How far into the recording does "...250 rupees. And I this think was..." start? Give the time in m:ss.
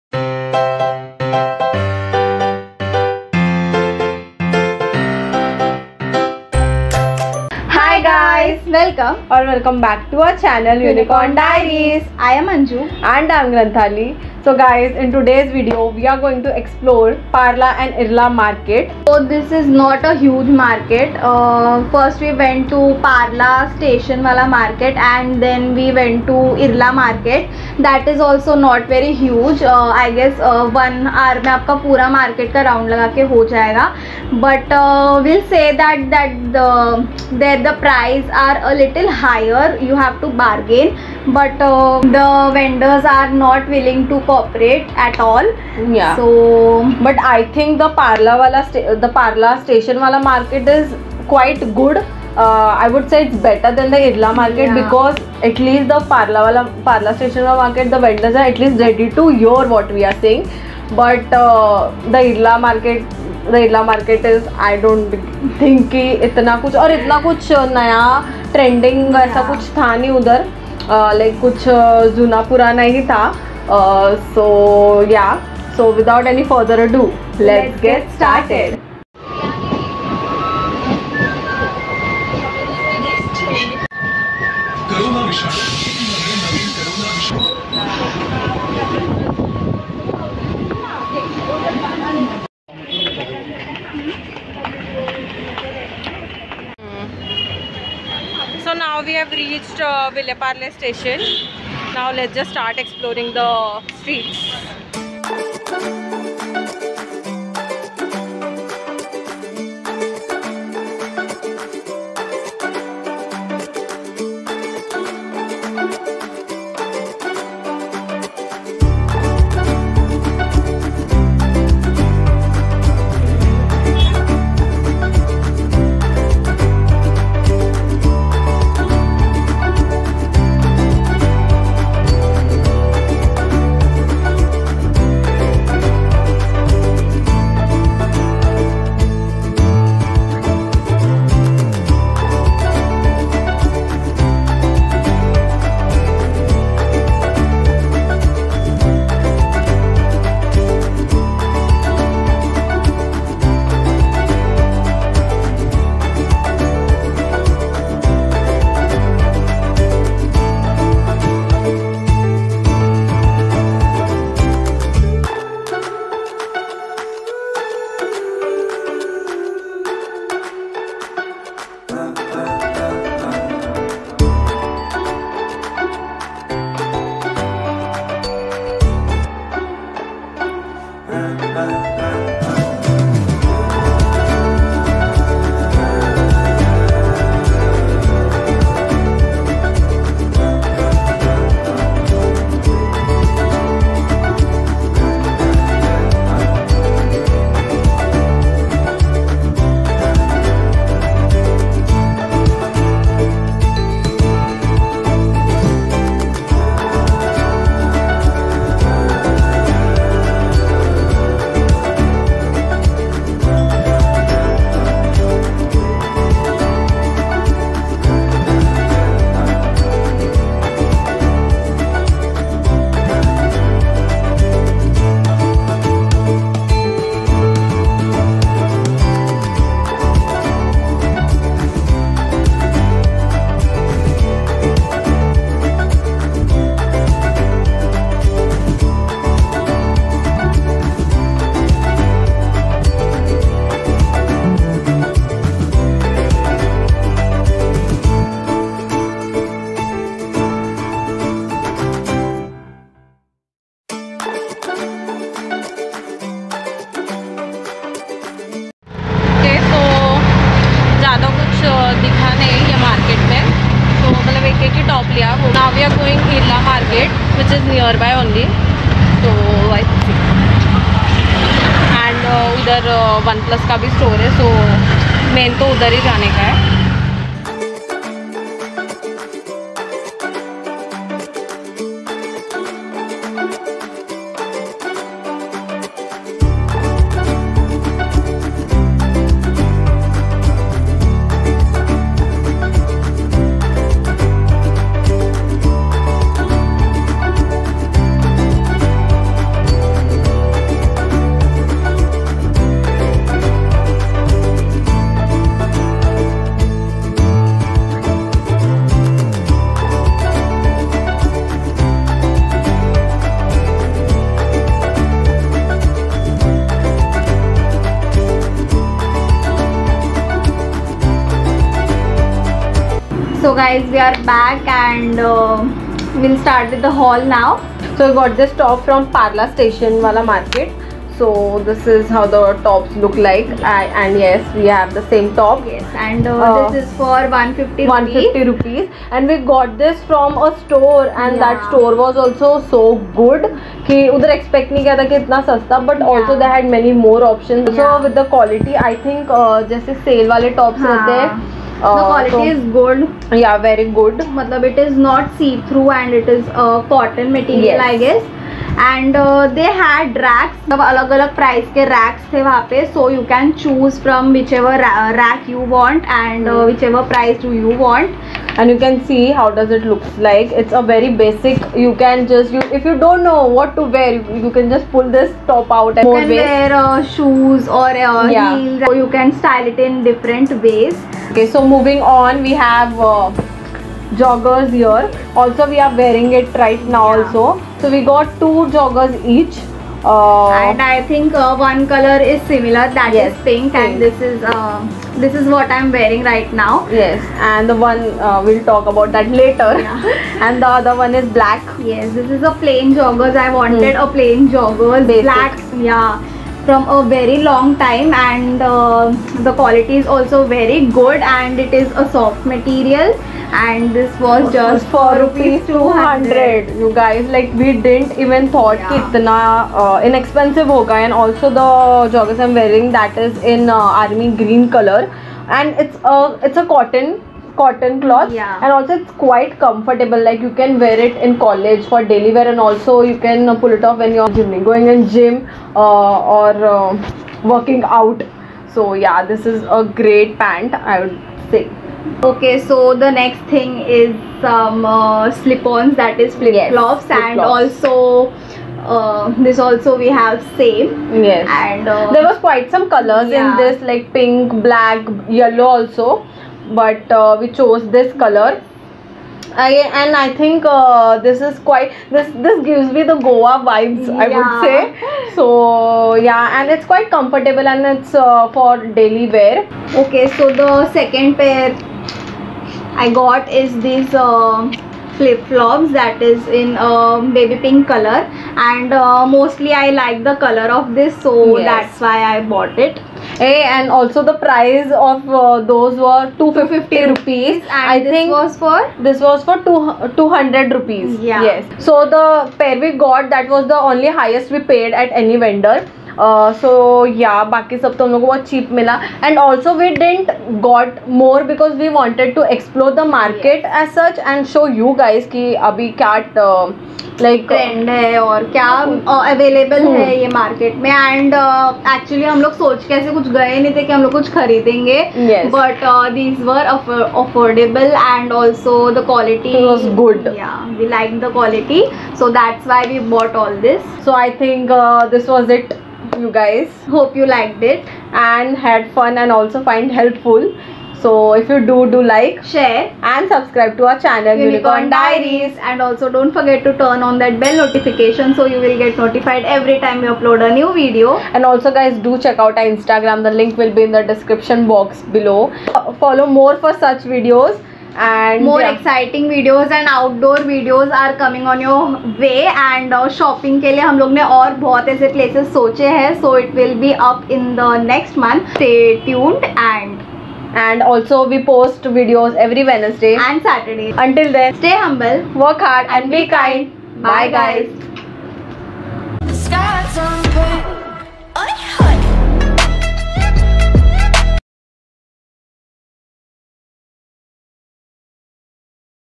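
8:06.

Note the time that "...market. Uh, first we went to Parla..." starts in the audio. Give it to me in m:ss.
0:20.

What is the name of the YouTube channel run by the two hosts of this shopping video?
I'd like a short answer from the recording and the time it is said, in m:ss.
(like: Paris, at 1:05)
Unicorn Diaries, at 0:10.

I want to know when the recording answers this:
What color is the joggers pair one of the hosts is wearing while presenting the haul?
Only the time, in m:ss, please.
7:04.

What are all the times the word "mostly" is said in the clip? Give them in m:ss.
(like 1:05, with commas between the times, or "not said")
7:59.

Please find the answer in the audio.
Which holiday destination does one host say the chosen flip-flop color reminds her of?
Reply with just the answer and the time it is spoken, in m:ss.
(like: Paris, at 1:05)
Goa, at 7:43.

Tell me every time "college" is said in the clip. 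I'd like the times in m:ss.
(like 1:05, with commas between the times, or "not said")
7:11.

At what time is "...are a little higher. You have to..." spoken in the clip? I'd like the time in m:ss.
0:38.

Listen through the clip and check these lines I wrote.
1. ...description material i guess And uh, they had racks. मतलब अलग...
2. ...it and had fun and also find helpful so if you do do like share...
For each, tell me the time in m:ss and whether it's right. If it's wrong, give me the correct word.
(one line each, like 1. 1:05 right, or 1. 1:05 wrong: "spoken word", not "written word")
1. 5:56 wrong: "cotton", not "description"
2. 8:47 right.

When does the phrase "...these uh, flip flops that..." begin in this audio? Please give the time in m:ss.
7:53.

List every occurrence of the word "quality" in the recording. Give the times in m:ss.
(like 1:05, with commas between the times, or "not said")
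5:52, 6:49.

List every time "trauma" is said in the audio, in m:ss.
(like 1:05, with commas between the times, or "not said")
not said.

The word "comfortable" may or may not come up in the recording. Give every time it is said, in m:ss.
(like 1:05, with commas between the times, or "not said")
7:09, 7:47.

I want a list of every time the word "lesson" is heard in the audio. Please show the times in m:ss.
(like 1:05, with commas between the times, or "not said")
not said.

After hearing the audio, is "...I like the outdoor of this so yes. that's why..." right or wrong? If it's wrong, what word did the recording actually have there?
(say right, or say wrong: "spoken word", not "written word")
wrong: "color", not "outdoor".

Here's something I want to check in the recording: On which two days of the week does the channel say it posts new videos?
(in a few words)
Wednesday and Saturday.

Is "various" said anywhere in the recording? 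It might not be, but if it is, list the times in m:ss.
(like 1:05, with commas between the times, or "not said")
not said.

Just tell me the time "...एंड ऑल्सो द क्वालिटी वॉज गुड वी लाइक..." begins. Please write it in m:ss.
8:37.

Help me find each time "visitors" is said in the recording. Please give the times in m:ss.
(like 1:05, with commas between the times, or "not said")
not said.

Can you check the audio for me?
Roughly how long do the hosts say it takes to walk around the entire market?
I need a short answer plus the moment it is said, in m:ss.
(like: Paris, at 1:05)
one hour, at 0:30.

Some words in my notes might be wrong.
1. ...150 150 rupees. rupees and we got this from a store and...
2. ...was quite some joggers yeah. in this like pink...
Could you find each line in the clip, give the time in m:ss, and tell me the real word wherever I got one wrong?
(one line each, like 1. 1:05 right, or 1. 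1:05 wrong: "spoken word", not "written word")
1. 5:37 right
2. 7:32 wrong: "colors", not "joggers".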